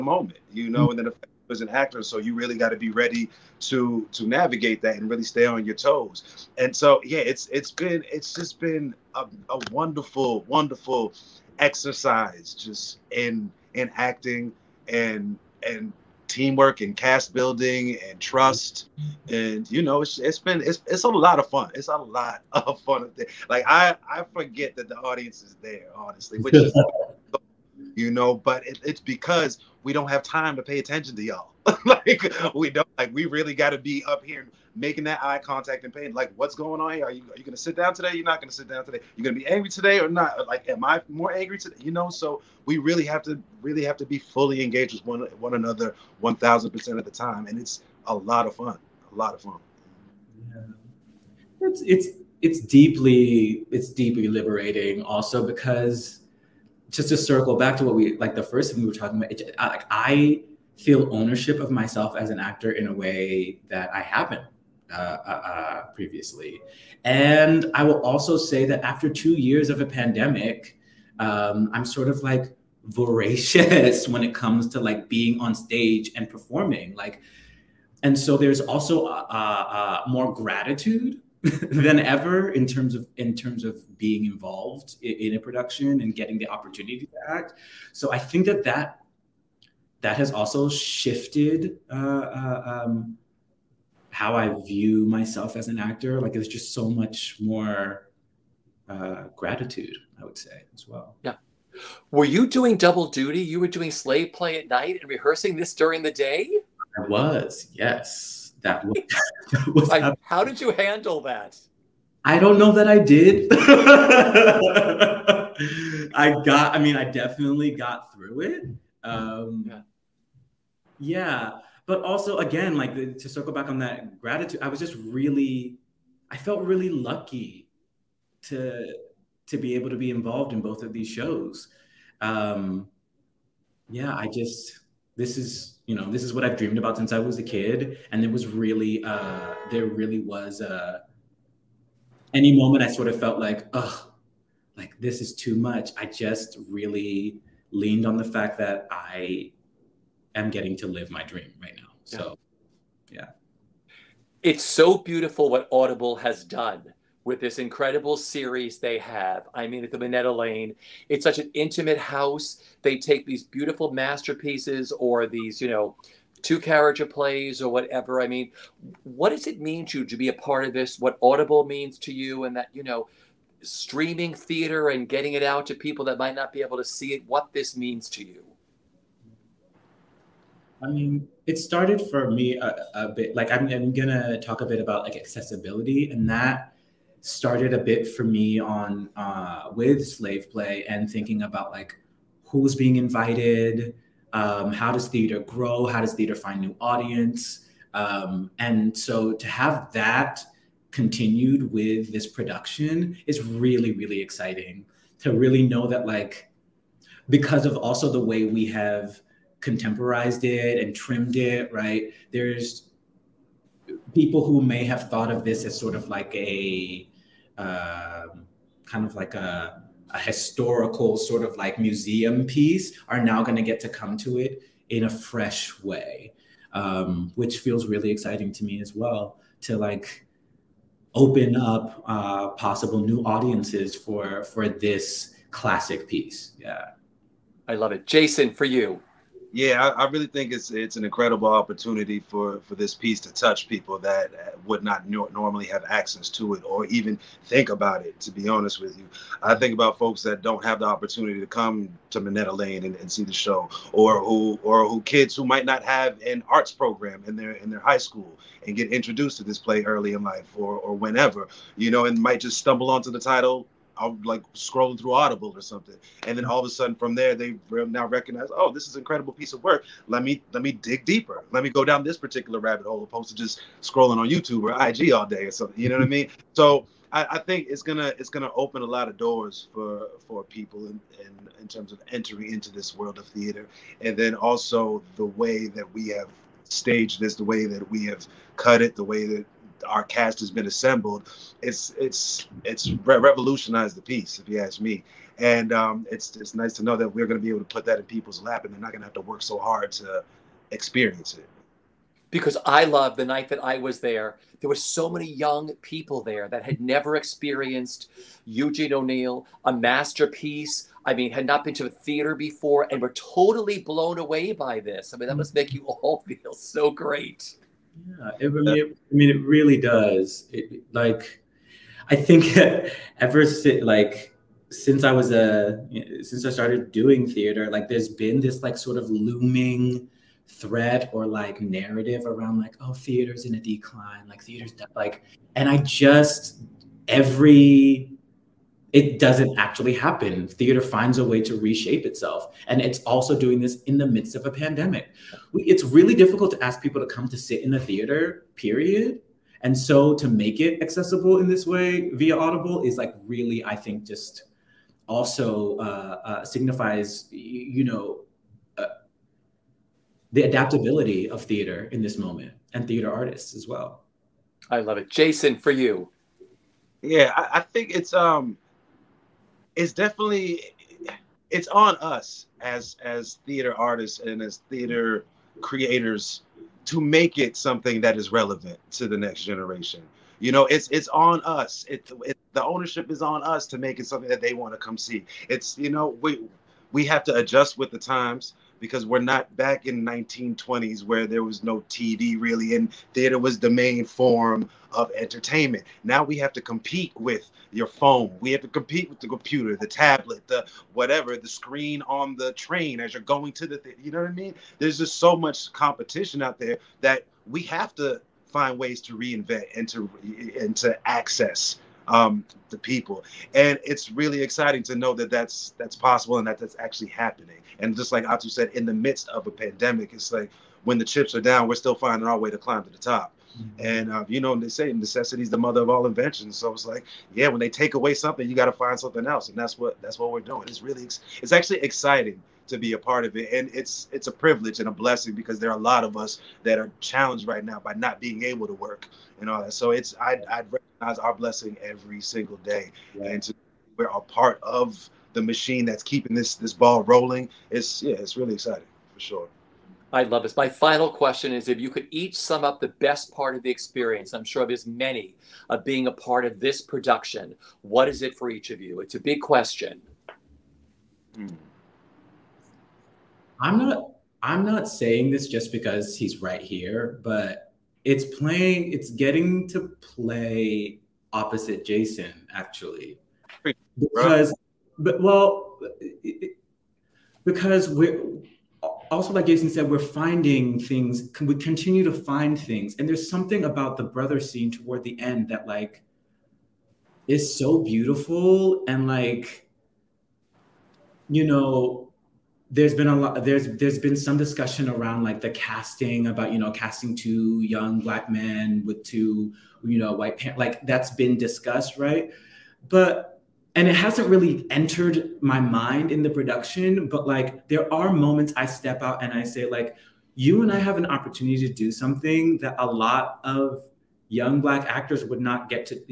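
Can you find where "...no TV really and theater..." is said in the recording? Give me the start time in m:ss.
6:31.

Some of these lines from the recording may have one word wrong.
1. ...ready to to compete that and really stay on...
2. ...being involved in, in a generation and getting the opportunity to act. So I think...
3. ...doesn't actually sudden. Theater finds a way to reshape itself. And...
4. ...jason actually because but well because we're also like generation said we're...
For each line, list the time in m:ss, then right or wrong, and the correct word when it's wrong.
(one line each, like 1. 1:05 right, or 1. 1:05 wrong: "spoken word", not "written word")
1. 0:02 wrong: "navigate", not "compete"
2. 1:23 wrong: "production", not "generation"
3. 5:39 wrong: "happen", not "sudden"
4. 7:51 wrong: "jason", not "generation".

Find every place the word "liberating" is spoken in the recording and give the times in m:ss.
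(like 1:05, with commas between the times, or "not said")
0:54.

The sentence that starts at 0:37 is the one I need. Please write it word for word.
Are you are you gonna sit down today?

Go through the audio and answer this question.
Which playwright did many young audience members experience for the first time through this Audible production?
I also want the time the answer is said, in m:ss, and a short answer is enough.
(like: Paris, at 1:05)
Eugene O'Neill, at 5:08.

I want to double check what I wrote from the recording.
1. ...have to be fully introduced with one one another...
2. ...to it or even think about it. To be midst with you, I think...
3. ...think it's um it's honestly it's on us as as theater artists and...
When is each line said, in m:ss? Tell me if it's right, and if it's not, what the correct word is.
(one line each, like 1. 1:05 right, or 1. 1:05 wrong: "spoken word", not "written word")
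1. 0:43 wrong: "engaged", not "introduced"
2. 4:06 wrong: "honest", not "midst"
3. 6:07 wrong: "definitely", not "honestly".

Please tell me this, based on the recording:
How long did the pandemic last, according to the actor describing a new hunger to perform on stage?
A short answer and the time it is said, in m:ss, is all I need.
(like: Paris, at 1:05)
2 years, at 1:09.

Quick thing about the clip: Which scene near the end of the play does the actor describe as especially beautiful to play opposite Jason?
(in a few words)
The brother scene.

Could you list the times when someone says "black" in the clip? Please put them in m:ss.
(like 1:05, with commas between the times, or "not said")
8:17, 8:34.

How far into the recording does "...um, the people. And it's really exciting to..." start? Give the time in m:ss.
6:52.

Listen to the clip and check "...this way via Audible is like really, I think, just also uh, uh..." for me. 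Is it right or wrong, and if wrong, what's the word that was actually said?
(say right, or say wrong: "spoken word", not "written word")
right.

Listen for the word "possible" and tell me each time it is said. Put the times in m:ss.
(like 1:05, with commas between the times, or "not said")
3:52, 6:55.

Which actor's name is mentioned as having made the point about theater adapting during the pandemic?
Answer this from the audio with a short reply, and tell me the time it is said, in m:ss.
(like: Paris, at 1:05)
Ato, at 6:58.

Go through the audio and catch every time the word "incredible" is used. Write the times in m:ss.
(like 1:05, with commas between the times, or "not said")
2:37, 4:01, 4:29.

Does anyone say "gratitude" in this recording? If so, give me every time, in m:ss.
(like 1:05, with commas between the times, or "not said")
1:20, 1:39, 2:04.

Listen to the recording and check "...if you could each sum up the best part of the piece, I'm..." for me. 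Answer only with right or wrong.
wrong.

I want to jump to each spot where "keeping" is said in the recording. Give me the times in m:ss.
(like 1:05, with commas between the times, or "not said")
7:26.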